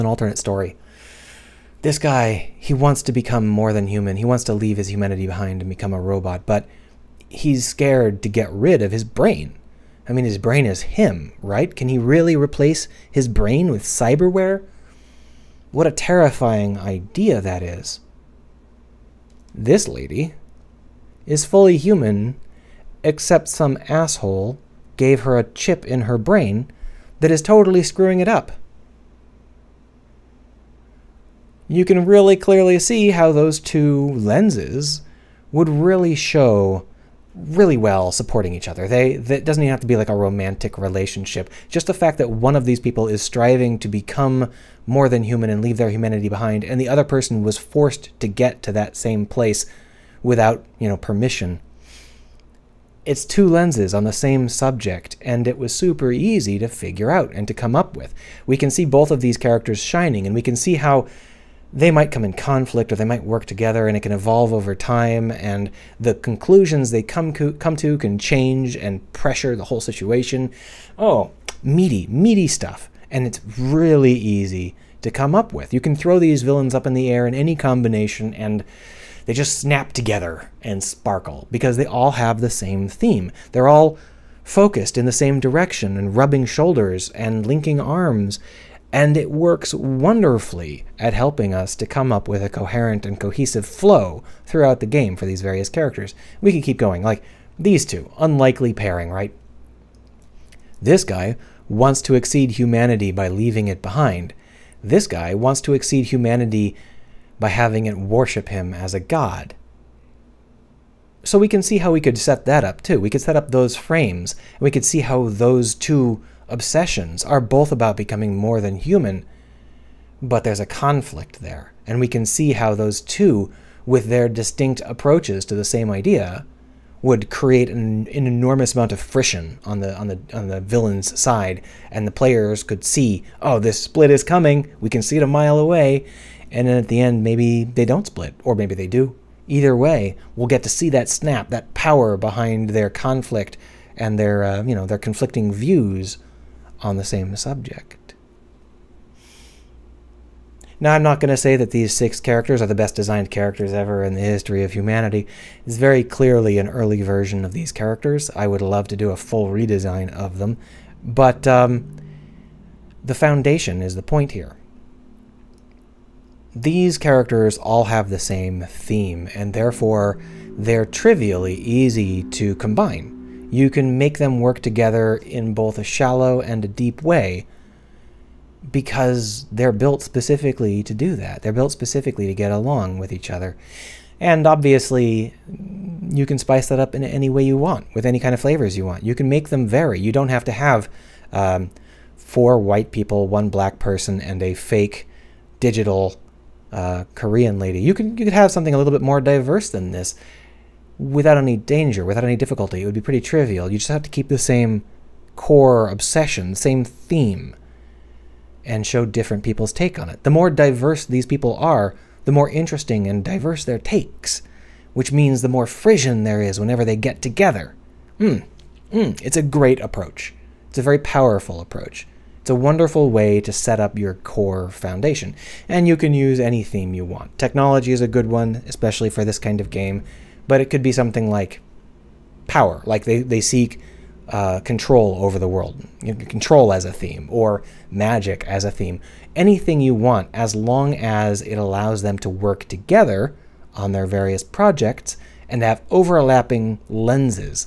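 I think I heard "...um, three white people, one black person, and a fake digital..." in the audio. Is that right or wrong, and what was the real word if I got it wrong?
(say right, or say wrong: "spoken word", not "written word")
wrong: "four", not "three".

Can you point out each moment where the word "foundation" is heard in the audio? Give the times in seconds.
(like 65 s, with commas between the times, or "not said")
163 s, 224 s.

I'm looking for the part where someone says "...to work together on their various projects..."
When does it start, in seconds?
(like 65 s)
242 s.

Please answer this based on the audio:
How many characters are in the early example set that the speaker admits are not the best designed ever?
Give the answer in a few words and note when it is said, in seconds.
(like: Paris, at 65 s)
6, at 151 s.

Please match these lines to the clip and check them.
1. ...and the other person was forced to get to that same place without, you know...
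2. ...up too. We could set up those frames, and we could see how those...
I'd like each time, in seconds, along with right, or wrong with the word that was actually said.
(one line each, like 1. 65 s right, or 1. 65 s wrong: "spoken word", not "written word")
1. 46 s right
2. 112 s right.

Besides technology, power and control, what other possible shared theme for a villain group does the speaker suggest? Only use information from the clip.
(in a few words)
Magic.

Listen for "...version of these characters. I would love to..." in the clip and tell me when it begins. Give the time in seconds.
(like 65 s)
156 s.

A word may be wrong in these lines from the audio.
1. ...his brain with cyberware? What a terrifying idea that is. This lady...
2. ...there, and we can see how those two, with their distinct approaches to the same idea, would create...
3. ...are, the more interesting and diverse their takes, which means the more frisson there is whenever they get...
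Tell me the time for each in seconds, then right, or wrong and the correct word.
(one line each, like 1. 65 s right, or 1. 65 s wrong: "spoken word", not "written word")
1. 13 s right
2. 121 s right
3. 211 s right.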